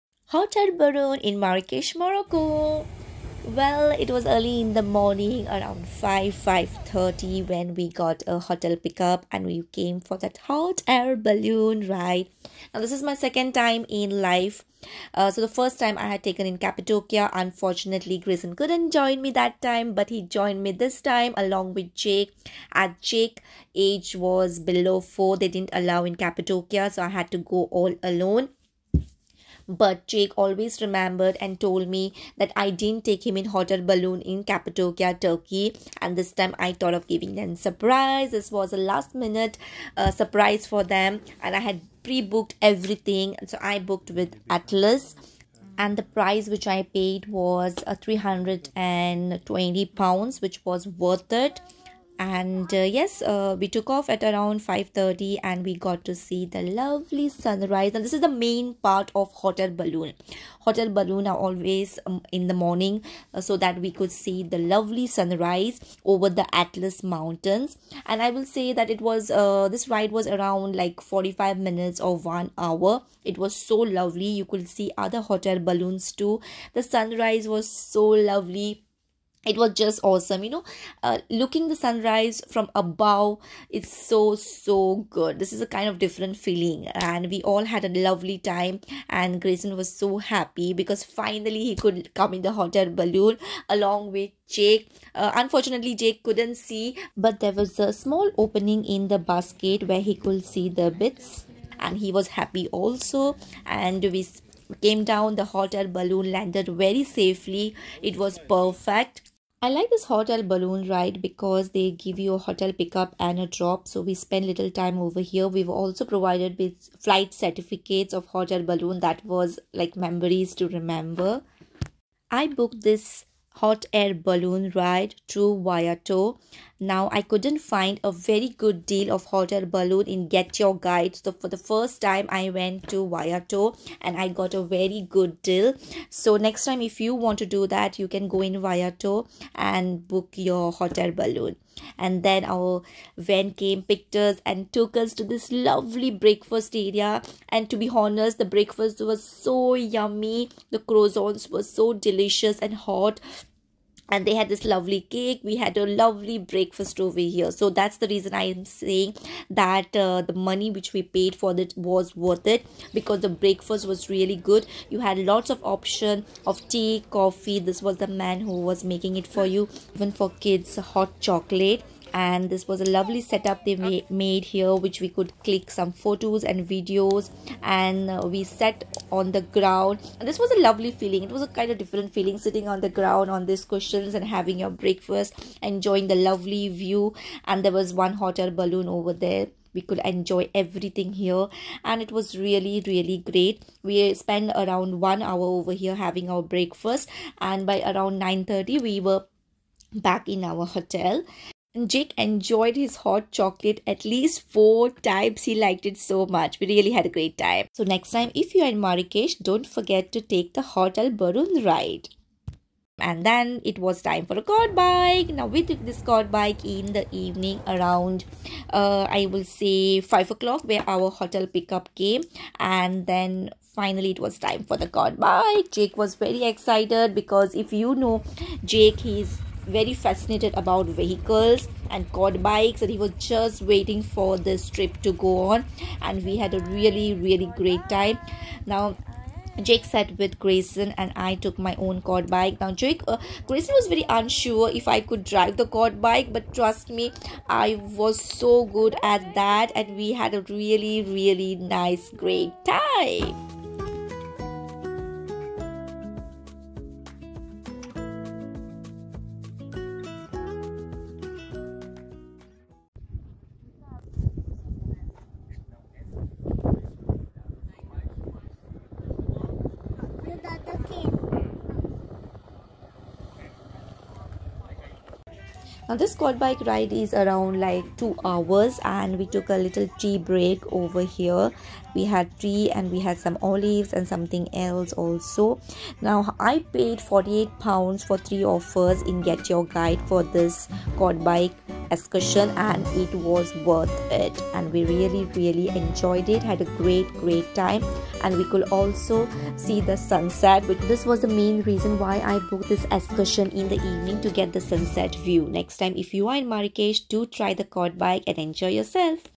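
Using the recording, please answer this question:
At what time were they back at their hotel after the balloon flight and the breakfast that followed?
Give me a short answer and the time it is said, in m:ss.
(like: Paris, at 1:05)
9:30, at 3:18.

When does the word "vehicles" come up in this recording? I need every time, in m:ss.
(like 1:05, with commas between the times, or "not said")
3:50.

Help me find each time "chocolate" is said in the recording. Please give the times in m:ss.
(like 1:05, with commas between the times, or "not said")
2:51, 3:23.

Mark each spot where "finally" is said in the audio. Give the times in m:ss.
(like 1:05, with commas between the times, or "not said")
1:31, 3:43.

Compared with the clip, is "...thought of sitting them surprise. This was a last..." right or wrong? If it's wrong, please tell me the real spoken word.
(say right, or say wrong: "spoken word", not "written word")
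wrong: "giving", not "sitting".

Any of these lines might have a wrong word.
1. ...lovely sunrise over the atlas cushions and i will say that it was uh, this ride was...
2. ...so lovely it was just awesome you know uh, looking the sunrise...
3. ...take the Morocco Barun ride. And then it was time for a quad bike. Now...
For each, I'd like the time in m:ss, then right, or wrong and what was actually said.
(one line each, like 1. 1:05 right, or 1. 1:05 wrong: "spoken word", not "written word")
1. 1:04 wrong: "mountains", not "cushions"
2. 1:17 right
3. 3:30 wrong: "Hotel", not "Morocco".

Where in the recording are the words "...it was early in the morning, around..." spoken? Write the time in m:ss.
0:03.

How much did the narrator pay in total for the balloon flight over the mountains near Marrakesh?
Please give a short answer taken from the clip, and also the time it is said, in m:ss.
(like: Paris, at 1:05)
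320 pounds, at 0:47.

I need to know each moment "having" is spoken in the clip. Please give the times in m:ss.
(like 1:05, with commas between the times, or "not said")
3:04, 3:15.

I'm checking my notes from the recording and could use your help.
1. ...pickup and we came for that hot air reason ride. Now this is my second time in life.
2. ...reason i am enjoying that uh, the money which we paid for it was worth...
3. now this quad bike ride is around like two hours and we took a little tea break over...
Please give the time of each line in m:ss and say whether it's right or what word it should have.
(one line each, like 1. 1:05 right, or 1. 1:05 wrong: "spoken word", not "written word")
1. 0:08 wrong: "balloon", not "reason"
2. 2:38 wrong: "saying", not "enjoying"
3. 4:35 right.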